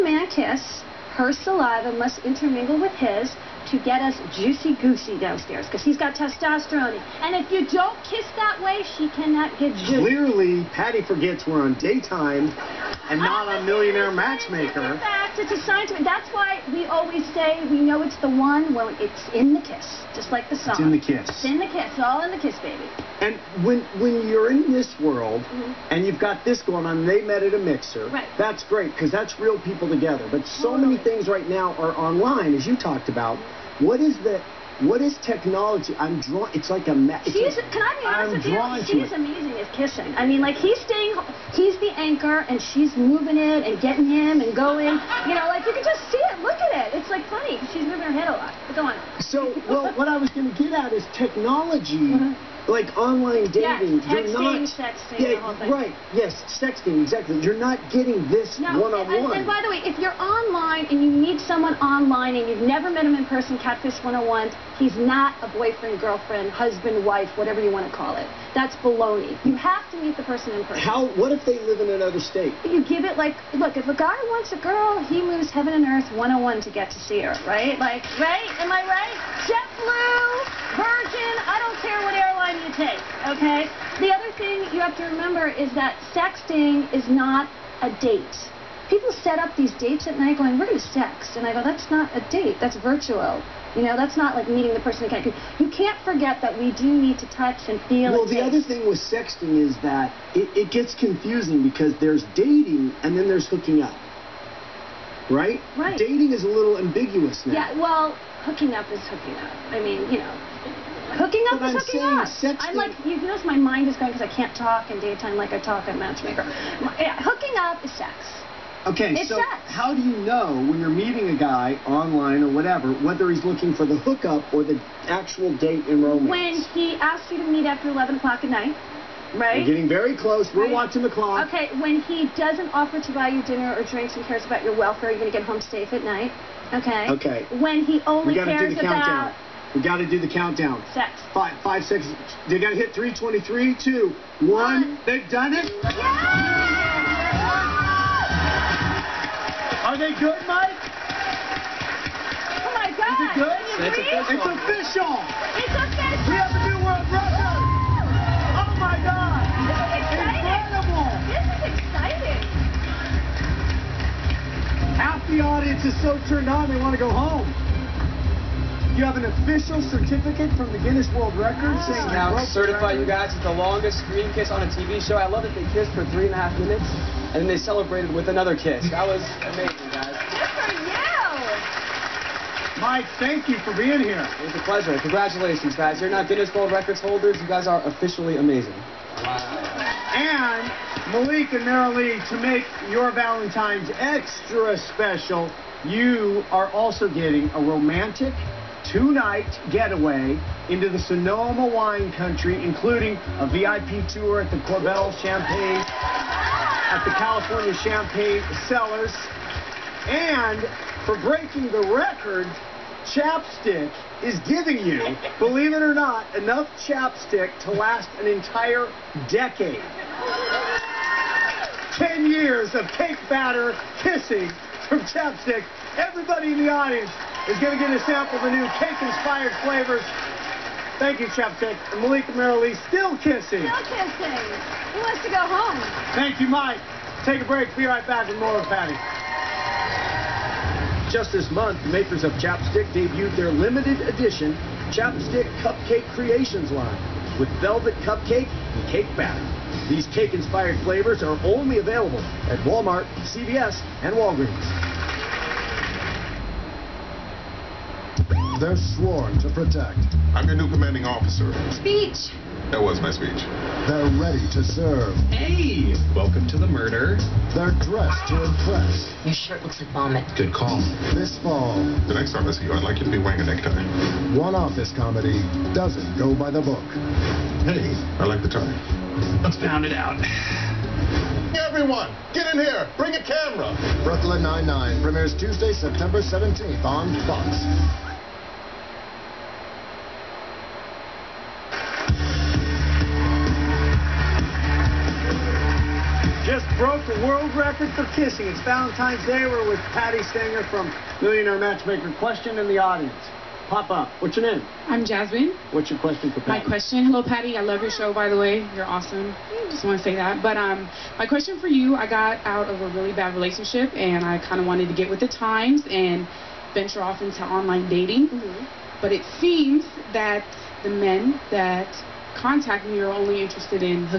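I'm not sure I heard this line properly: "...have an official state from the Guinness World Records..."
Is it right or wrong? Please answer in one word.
wrong.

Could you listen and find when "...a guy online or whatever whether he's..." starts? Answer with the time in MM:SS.
02:01.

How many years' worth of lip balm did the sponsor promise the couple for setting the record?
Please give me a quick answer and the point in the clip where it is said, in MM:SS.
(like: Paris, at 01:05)
10, at 03:41.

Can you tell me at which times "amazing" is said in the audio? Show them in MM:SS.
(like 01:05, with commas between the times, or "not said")
00:39, 02:59, 03:08.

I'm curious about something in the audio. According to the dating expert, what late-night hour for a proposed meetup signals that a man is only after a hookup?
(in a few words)
11 o'clock.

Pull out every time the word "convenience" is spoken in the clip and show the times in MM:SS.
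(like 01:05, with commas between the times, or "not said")
not said.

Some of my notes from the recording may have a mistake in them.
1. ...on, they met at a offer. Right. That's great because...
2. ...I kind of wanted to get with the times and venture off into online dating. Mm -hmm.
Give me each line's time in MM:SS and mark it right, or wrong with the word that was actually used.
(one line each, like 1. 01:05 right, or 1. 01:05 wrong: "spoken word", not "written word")
1. 00:26 wrong: "mixer", not "offer"
2. 05:14 right.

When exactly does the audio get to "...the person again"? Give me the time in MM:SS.
01:34.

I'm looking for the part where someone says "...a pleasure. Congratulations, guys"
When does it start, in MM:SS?
03:04.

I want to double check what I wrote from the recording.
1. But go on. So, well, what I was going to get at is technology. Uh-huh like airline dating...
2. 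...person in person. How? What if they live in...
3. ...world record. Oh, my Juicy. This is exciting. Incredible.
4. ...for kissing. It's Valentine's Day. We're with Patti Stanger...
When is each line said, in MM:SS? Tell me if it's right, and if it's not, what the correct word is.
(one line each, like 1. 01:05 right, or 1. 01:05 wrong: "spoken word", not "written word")
1. 00:48 wrong: "online", not "airline"
2. 01:10 right
3. 02:36 wrong: "God", not "Juicy"
4. 04:57 right.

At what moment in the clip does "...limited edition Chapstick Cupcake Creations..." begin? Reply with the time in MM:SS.
04:03.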